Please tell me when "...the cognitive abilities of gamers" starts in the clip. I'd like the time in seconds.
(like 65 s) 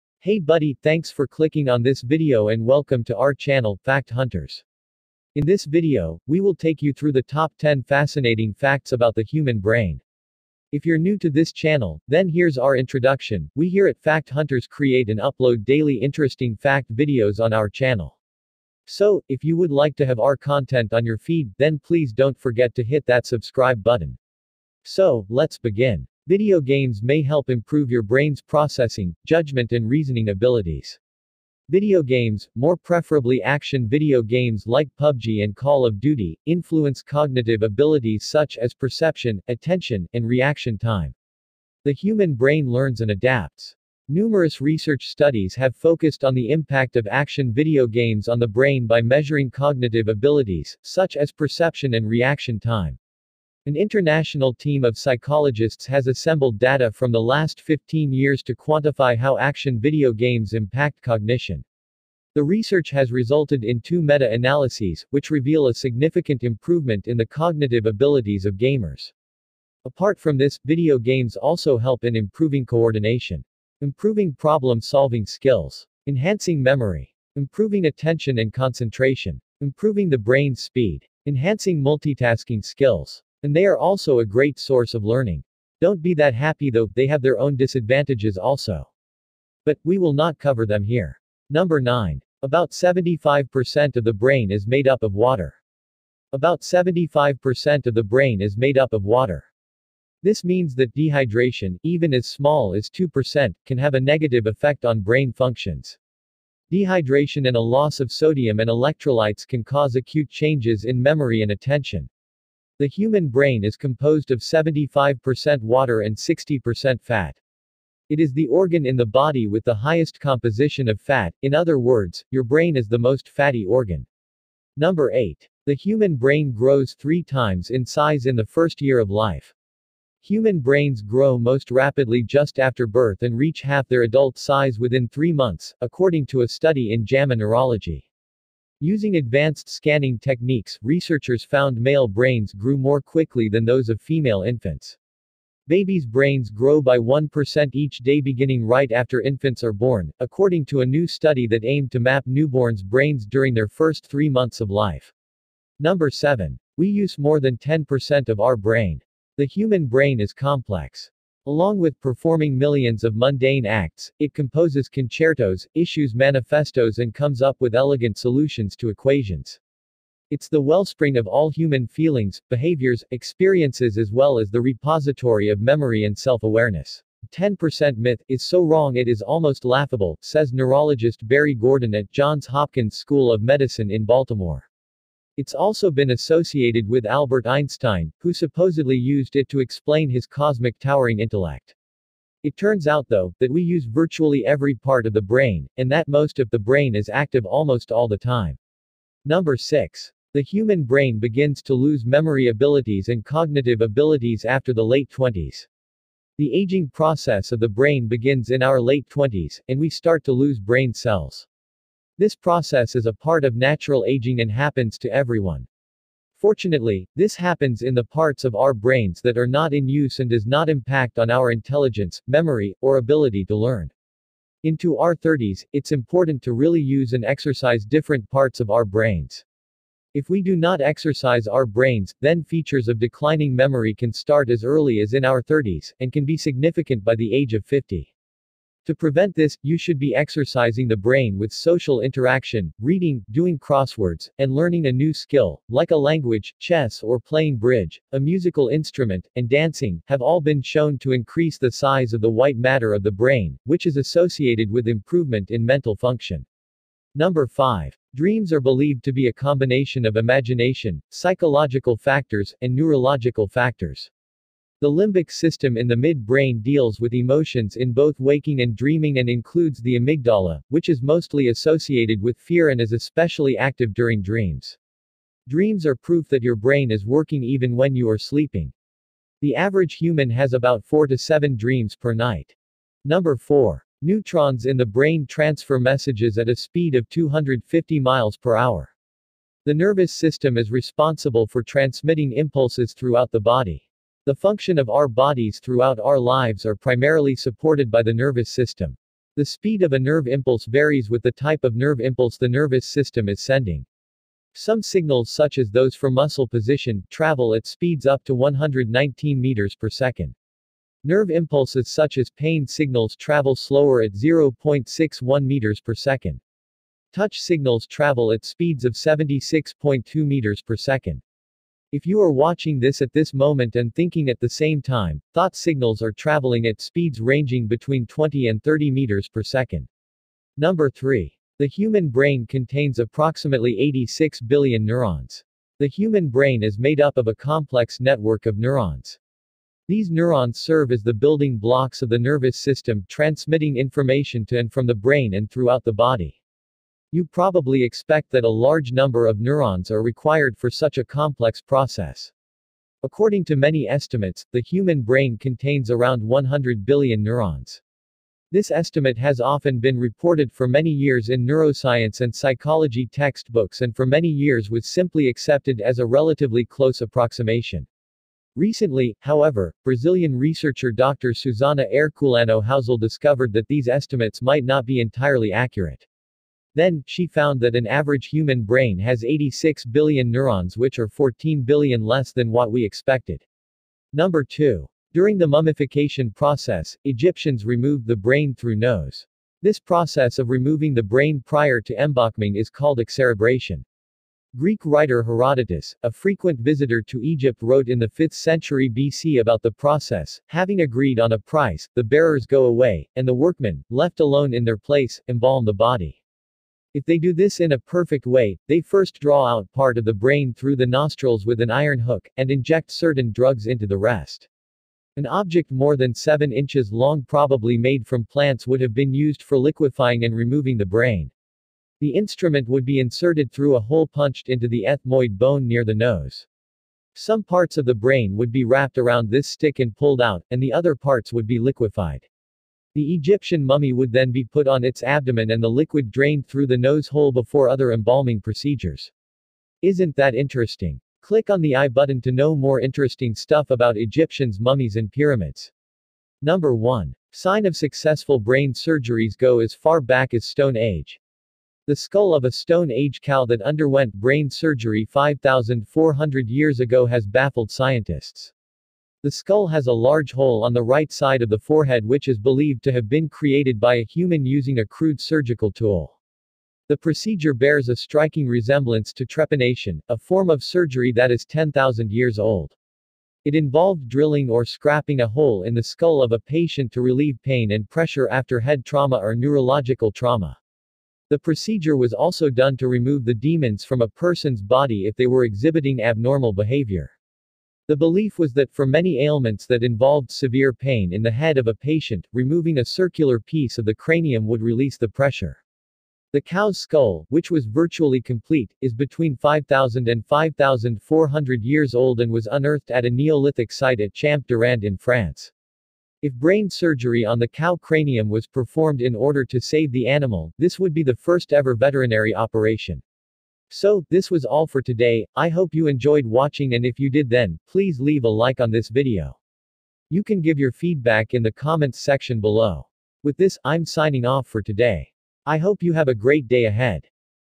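67 s.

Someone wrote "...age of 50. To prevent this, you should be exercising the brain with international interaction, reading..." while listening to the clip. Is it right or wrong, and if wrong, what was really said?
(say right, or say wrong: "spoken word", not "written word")
wrong: "social", not "international".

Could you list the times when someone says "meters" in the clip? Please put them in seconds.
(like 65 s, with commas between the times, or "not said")
309 s, 315 s, 320 s, 328 s.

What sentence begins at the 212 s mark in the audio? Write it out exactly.
This process is a part of natural aging and happens to everyone.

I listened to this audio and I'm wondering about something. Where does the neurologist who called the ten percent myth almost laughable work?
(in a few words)
Johns Hopkins School of Medicine.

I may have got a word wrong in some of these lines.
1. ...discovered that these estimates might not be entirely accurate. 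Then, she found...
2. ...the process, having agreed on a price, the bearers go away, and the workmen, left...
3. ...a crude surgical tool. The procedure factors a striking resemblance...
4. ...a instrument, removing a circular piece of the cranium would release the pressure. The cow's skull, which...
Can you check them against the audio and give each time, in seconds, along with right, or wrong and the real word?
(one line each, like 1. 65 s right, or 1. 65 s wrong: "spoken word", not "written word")
1. 372 s right
2. 399 s right
3. 464 s wrong: "bears", not "factors"
4. 491 s wrong: "patient", not "instrument".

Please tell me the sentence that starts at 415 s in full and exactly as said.
An object more than 7 inches long probably made from plants would have been used for liquefying and removing the brain.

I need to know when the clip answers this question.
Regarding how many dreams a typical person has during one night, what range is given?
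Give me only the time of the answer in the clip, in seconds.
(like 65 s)
280 s.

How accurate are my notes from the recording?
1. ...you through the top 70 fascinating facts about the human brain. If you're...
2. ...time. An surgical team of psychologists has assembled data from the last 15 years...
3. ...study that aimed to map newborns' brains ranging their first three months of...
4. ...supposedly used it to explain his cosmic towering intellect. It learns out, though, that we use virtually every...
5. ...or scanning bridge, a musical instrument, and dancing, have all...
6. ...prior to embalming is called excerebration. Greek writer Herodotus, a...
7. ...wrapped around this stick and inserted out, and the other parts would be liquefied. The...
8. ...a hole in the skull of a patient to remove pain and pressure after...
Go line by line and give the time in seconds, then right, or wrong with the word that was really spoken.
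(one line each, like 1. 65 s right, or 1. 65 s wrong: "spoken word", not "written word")
1. 6 s wrong: "10", not "70"
2. 52 s wrong: "international", not "surgical"
3. 151 s wrong: "during", not "ranging"
4. 188 s wrong: "turns", not "learns"
5. 247 s wrong: "playing", not "scanning"
6. 391 s right
7. 428 s wrong: "pulled", not "inserted"
8. 475 s wrong: "relieve", not "remove".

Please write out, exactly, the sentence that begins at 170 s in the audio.
It's the wellspring of all human feelings, behaviors, experiences as well as the repository of memory and self-awareness.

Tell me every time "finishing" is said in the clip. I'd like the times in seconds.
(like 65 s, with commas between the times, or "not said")
not said.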